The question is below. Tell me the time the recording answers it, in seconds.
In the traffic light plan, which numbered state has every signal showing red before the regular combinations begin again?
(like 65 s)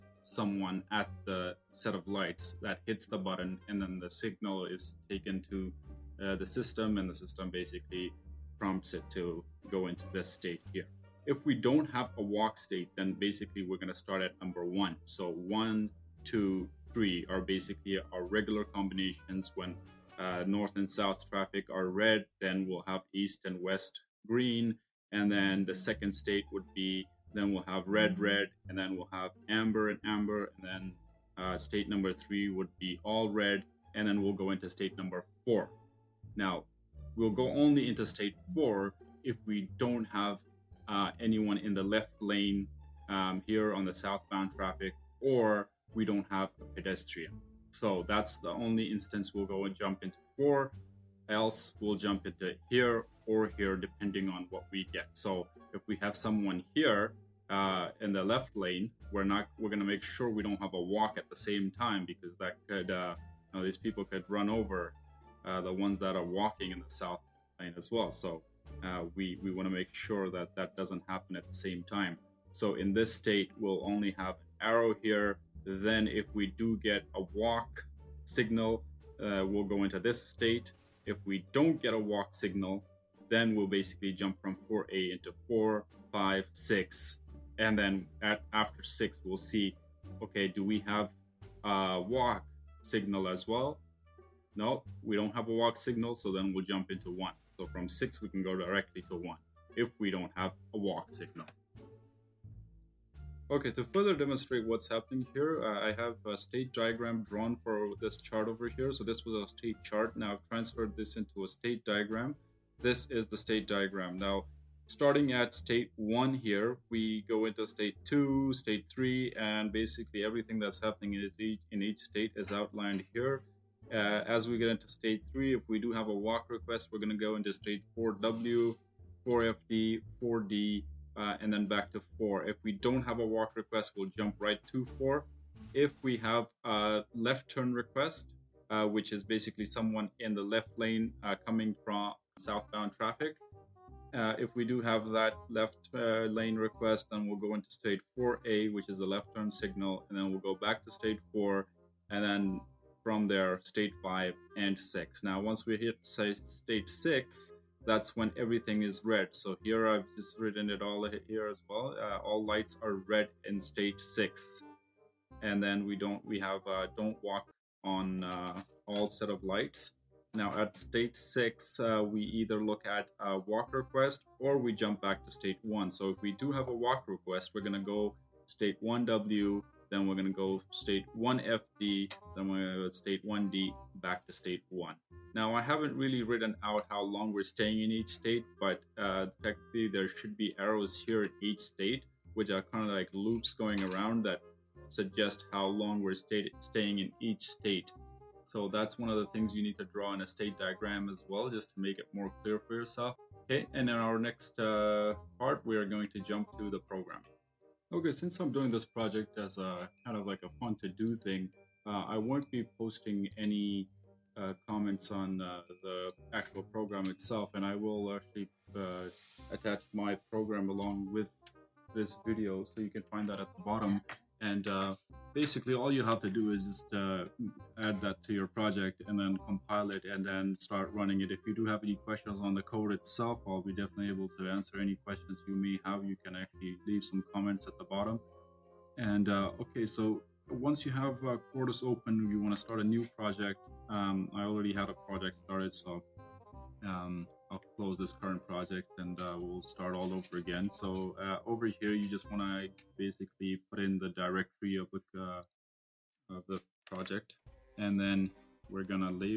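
31 s.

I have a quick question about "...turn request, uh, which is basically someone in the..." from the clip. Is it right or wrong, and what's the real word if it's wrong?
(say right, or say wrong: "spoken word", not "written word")
right.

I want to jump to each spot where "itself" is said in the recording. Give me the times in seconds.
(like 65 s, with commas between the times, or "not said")
217 s, 232 s.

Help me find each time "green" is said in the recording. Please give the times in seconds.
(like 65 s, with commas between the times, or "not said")
24 s.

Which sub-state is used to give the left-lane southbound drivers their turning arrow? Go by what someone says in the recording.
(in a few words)
4A.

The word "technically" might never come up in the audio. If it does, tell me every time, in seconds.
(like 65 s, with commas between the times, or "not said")
189 s.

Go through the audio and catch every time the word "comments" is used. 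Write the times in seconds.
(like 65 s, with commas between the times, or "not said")
214 s, 237 s.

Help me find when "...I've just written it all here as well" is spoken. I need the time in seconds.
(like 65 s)
159 s.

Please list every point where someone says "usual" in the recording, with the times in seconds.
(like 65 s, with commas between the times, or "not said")
not said.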